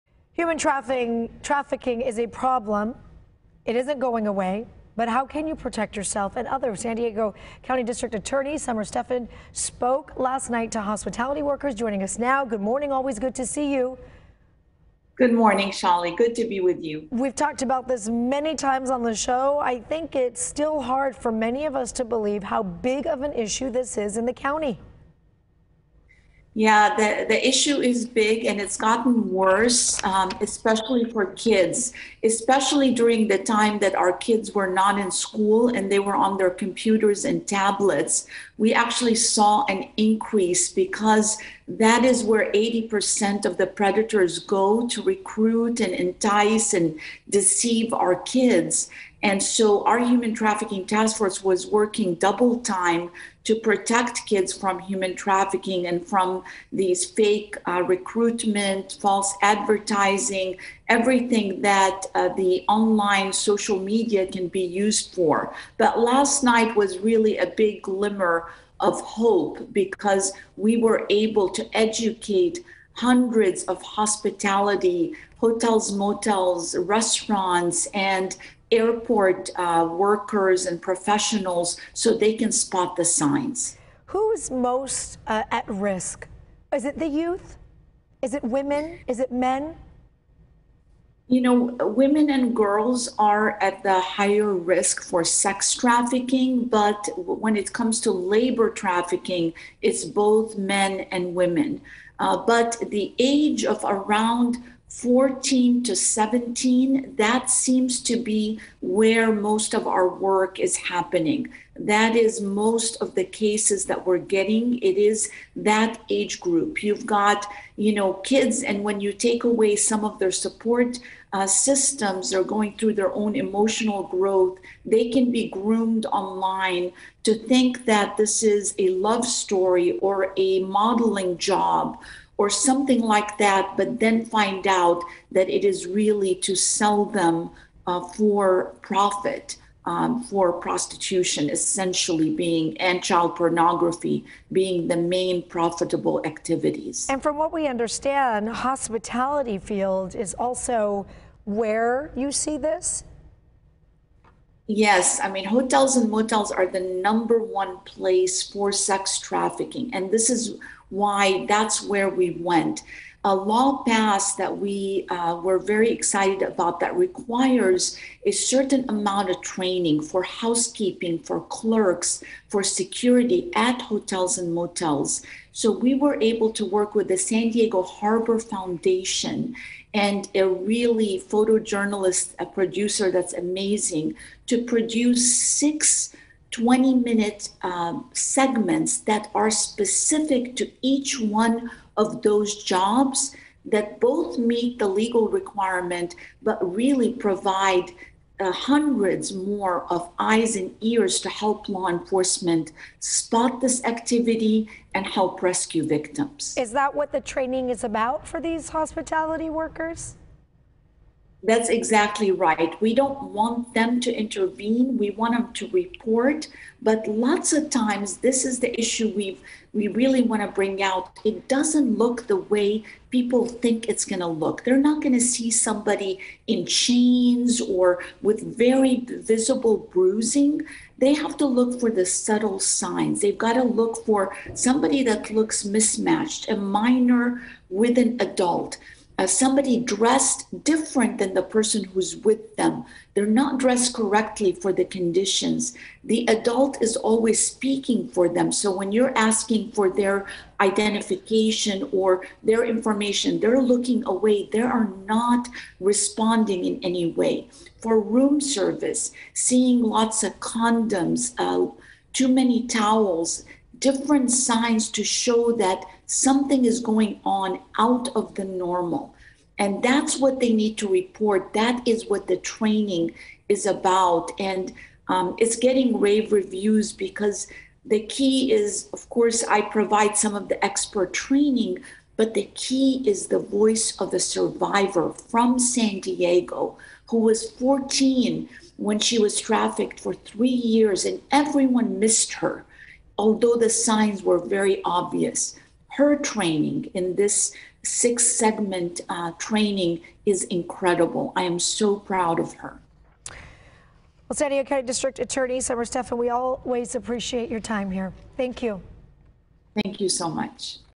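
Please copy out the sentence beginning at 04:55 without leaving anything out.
Her training in this six segment uh, training is incredible.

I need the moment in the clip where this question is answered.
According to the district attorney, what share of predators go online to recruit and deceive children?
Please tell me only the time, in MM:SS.
00:42.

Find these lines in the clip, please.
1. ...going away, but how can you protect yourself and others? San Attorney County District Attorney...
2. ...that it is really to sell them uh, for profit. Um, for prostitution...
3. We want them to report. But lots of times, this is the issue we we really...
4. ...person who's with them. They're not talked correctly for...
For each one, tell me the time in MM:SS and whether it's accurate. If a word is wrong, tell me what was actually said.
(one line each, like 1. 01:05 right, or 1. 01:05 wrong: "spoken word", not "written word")
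1. 00:03 wrong: "Diego", not "Attorney"
2. 02:15 right
3. 03:34 right
4. 04:01 wrong: "dressed", not "talked".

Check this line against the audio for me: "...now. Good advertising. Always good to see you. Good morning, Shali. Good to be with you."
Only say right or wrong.
wrong.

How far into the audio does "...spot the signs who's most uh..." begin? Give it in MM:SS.
01:22.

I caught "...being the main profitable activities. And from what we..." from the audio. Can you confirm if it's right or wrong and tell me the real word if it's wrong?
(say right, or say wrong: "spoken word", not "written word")
right.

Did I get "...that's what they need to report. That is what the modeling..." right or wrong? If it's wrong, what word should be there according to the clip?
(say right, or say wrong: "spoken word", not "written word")
wrong: "training", not "modeling".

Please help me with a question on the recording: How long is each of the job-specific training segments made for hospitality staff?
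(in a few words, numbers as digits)
20 minutes.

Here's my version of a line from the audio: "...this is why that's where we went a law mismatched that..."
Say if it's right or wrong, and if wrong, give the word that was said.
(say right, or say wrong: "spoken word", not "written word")
wrong: "passed", not "mismatched".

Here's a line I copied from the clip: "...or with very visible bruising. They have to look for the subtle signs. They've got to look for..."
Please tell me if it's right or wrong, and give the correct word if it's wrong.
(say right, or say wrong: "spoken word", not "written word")
right.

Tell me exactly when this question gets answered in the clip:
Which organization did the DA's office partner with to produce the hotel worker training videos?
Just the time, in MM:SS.
02:57.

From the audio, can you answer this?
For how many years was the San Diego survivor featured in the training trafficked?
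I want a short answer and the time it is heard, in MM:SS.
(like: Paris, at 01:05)
3, at 04:50.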